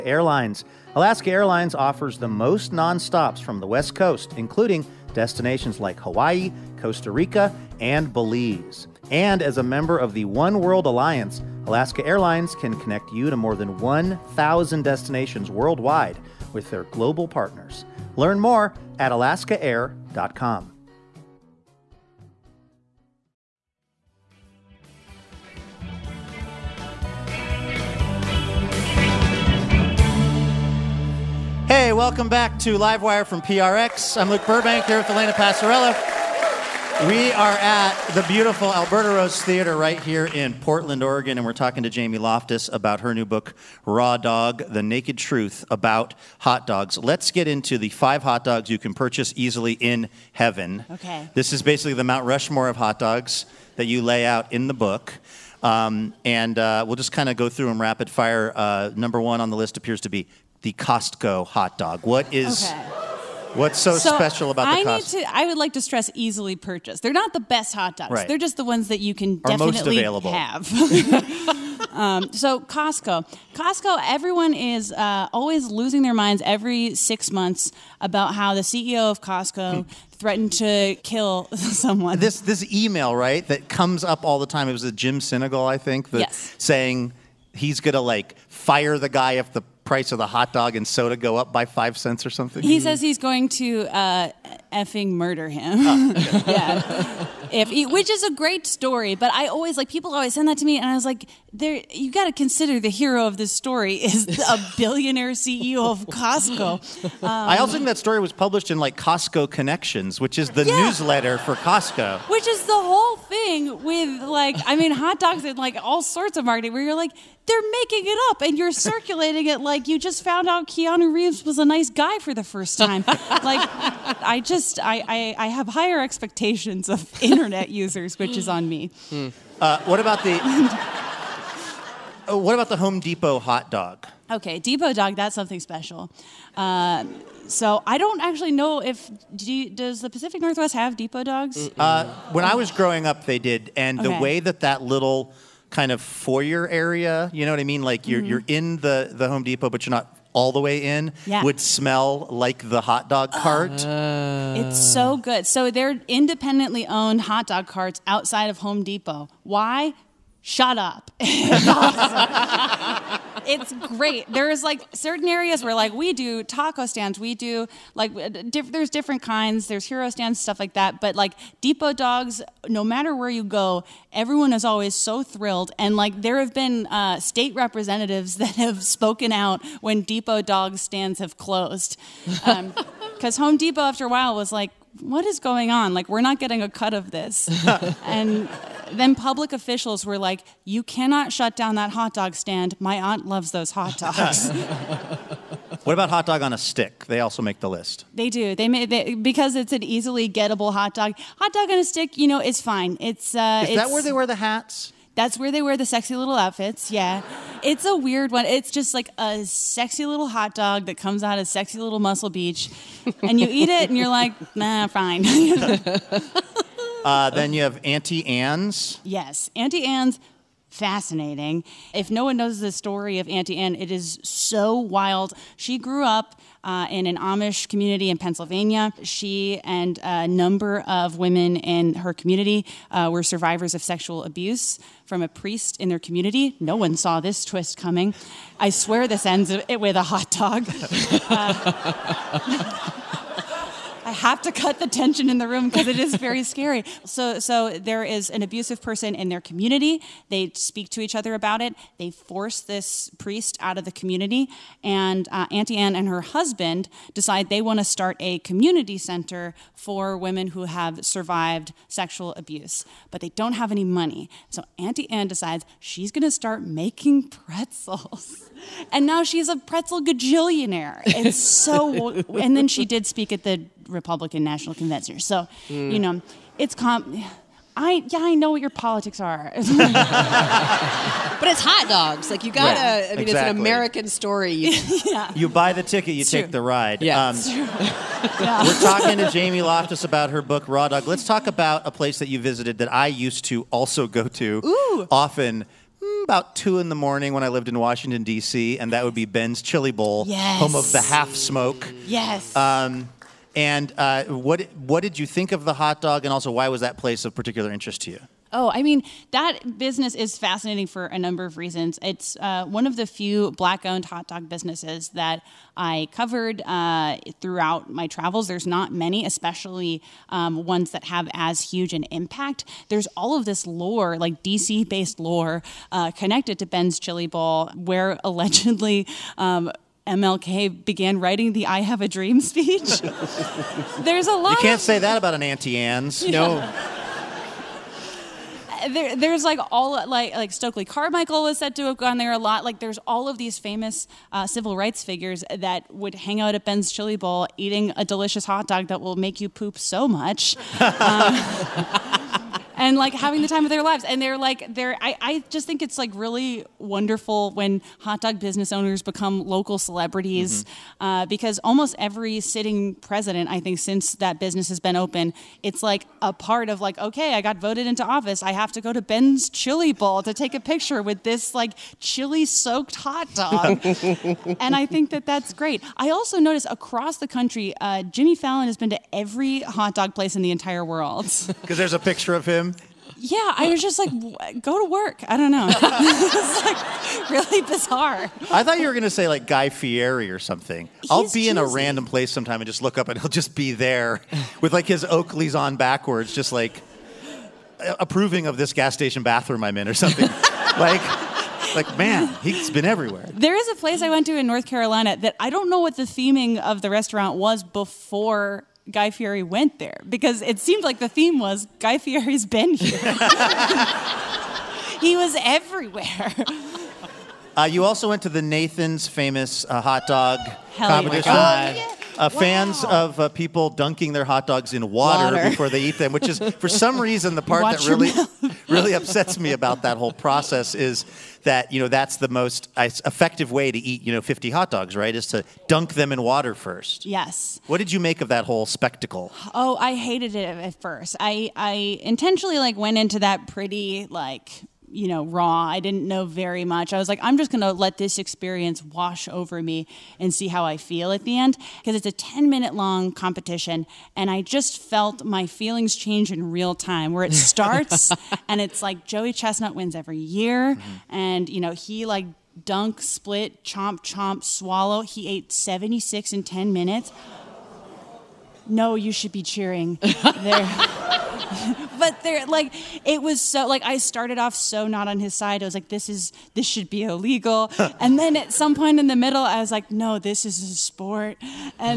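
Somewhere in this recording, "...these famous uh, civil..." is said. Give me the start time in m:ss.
5:43.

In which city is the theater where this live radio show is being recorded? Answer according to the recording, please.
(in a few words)
Portland, Oregon.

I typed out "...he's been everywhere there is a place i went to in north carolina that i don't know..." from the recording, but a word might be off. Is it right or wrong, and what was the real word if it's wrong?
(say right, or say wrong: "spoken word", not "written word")
right.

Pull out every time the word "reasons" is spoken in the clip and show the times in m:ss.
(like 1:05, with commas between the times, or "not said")
5:11, 7:06.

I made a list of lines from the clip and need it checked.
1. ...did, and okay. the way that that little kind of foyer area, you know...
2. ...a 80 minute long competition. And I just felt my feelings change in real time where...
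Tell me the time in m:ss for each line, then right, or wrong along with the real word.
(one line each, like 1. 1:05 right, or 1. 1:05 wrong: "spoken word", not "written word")
1. 2:23 right
2. 7:32 wrong: "10", not "80".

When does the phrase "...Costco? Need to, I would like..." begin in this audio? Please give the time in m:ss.
1:04.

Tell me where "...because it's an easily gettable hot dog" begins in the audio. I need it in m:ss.
3:19.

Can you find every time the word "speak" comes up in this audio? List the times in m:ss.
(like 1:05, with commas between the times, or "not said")
4:10, 4:33.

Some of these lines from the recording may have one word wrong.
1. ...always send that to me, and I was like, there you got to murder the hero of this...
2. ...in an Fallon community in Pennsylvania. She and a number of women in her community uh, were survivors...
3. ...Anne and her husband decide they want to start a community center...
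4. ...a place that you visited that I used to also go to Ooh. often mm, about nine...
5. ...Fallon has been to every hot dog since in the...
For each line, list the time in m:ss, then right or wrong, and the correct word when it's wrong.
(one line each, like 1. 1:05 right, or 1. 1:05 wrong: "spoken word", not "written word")
1. 1:40 wrong: "consider", not "murder"
2. 3:46 wrong: "Amish", not "Fallon"
3. 4:15 right
4. 4:51 wrong: "two", not "nine"
5. 6:18 wrong: "place", not "since".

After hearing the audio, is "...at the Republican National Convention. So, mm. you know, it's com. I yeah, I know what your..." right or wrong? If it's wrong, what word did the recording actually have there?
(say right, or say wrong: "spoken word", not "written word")
right.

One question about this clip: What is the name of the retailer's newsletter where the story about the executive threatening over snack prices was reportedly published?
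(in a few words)
Costco Connections.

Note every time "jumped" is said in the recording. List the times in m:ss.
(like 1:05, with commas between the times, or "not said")
not said.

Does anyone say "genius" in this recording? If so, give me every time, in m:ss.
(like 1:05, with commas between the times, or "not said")
not said.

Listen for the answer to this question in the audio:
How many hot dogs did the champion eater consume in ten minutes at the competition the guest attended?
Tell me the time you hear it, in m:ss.
7:45.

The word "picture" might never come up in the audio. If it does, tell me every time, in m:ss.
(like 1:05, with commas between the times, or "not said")
6:10, 6:21.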